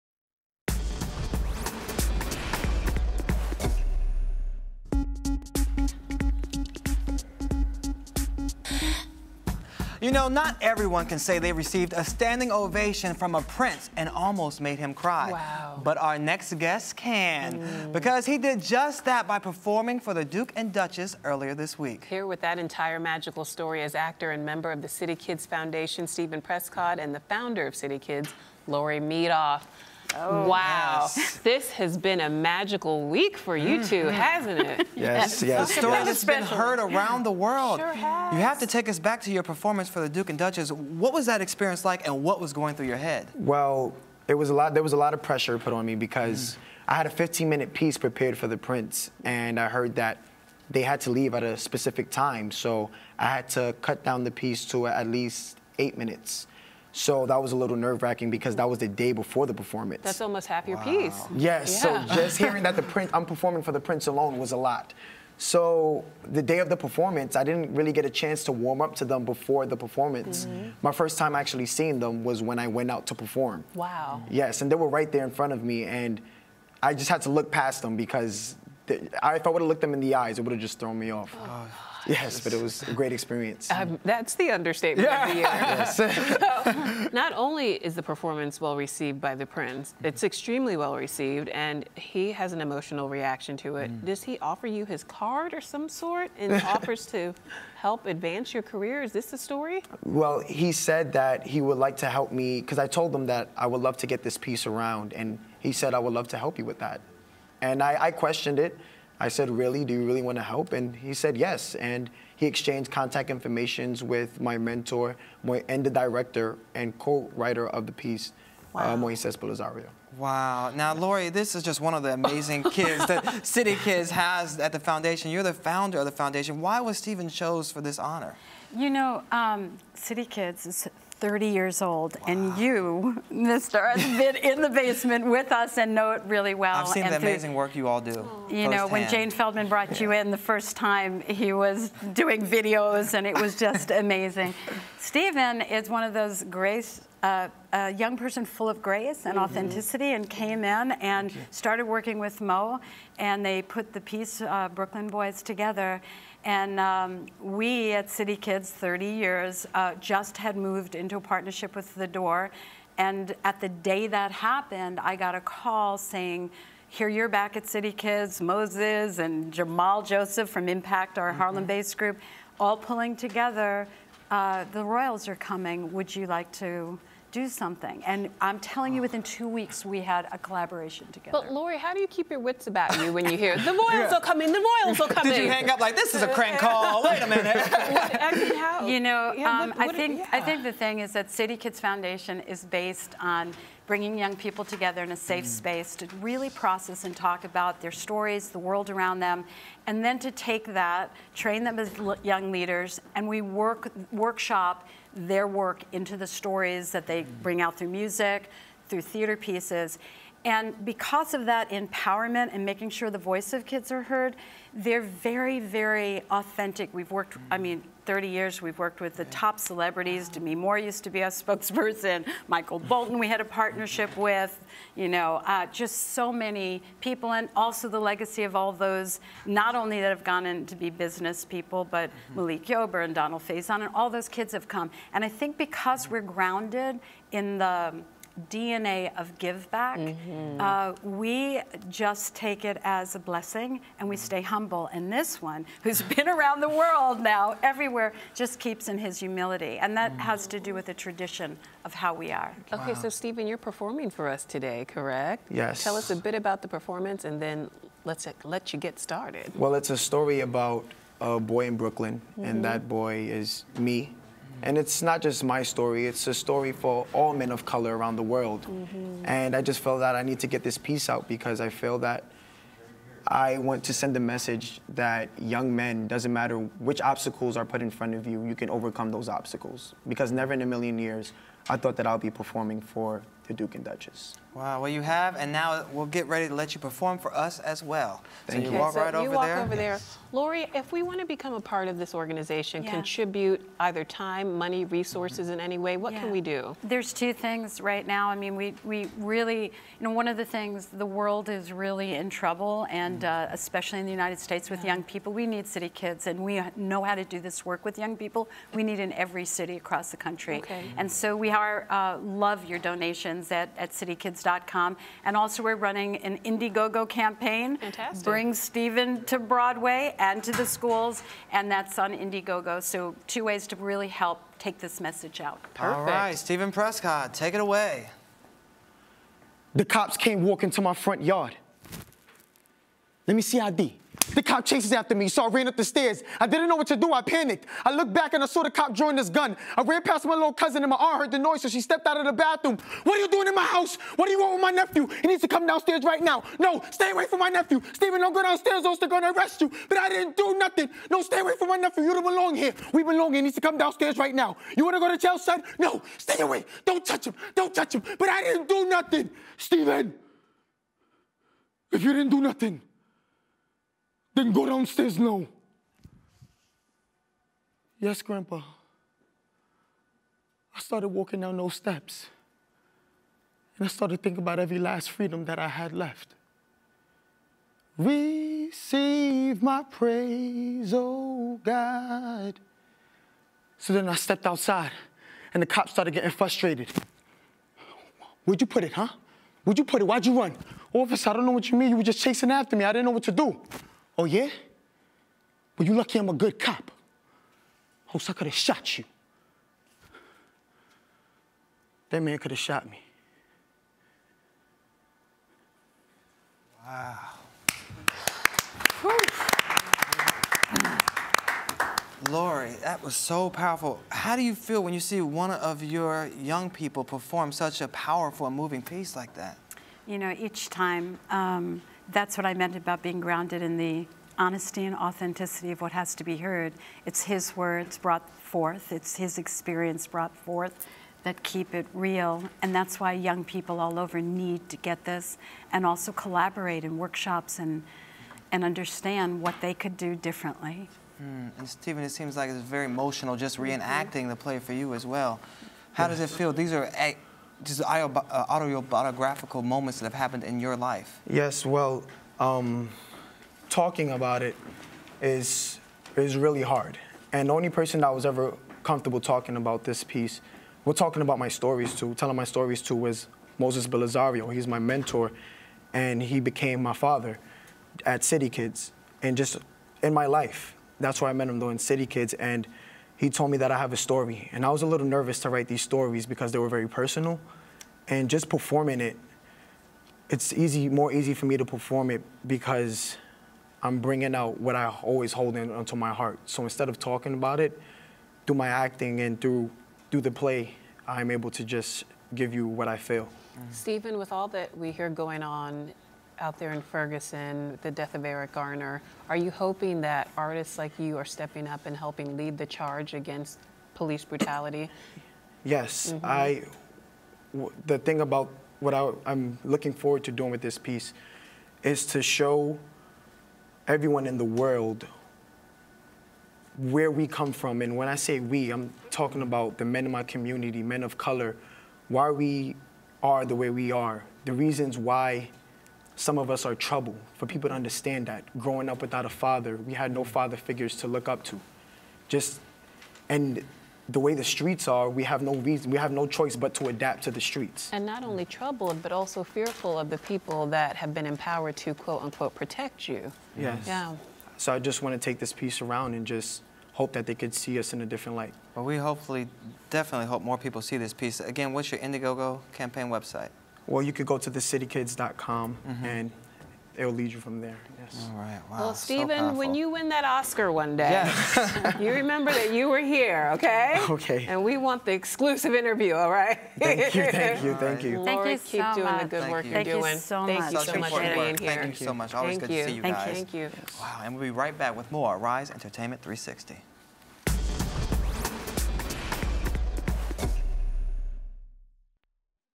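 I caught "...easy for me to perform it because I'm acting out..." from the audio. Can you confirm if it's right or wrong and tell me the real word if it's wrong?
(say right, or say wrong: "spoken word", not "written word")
wrong: "bringing", not "acting".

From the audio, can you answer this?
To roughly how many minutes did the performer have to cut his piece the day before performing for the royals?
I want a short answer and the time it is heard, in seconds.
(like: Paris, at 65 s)
8, at 55 s.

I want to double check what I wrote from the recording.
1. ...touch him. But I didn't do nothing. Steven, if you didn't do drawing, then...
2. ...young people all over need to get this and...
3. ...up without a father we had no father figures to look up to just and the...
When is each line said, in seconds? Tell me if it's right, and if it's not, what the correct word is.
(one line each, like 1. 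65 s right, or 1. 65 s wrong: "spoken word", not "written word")
1. 357 s wrong: "nothing", not "drawing"
2. 433 s right
3. 528 s right.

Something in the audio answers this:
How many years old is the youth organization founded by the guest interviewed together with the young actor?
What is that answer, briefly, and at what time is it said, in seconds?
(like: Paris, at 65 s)
30, at 131 s.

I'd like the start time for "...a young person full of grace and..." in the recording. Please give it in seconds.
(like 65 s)
147 s.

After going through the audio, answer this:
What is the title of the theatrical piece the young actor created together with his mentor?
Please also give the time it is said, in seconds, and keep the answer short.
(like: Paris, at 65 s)
Brooklyn Boys, at 154 s.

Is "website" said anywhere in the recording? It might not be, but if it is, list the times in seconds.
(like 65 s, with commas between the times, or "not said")
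553 s.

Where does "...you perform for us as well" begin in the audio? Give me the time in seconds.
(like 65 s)
286 s.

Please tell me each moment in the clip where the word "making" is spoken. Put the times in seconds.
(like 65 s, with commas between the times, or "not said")
212 s.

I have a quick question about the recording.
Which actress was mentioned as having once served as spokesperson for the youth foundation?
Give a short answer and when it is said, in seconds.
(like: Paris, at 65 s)
Demi Moore, at 220 s.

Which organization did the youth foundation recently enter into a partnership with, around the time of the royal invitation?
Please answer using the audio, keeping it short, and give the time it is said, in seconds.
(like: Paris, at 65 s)
The Door, at 161 s.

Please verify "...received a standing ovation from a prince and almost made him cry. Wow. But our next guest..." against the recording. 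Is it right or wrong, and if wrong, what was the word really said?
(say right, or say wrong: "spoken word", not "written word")
right.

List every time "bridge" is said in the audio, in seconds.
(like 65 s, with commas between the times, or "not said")
not said.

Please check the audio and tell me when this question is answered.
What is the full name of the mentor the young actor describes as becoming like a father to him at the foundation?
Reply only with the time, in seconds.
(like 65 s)
463 s.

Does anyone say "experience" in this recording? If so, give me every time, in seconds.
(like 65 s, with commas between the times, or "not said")
41 s, 83 s, 429 s.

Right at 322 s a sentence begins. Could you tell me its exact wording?
So, two ways to really help take this message out.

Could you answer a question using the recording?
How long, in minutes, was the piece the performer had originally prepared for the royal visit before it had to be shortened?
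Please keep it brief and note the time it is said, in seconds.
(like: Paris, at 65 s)
15, at 47 s.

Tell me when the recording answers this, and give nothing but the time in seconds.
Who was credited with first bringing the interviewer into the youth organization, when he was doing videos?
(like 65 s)
139 s.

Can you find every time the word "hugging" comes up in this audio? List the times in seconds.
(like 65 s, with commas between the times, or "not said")
not said.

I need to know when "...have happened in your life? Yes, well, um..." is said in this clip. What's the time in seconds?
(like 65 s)
450 s.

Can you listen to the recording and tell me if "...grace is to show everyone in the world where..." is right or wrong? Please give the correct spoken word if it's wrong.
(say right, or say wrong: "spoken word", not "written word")
wrong: "piece", not "grace".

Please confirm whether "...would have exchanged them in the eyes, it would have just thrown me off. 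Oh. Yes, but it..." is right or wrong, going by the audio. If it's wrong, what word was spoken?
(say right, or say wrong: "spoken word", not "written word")
wrong: "looked", not "exchanged".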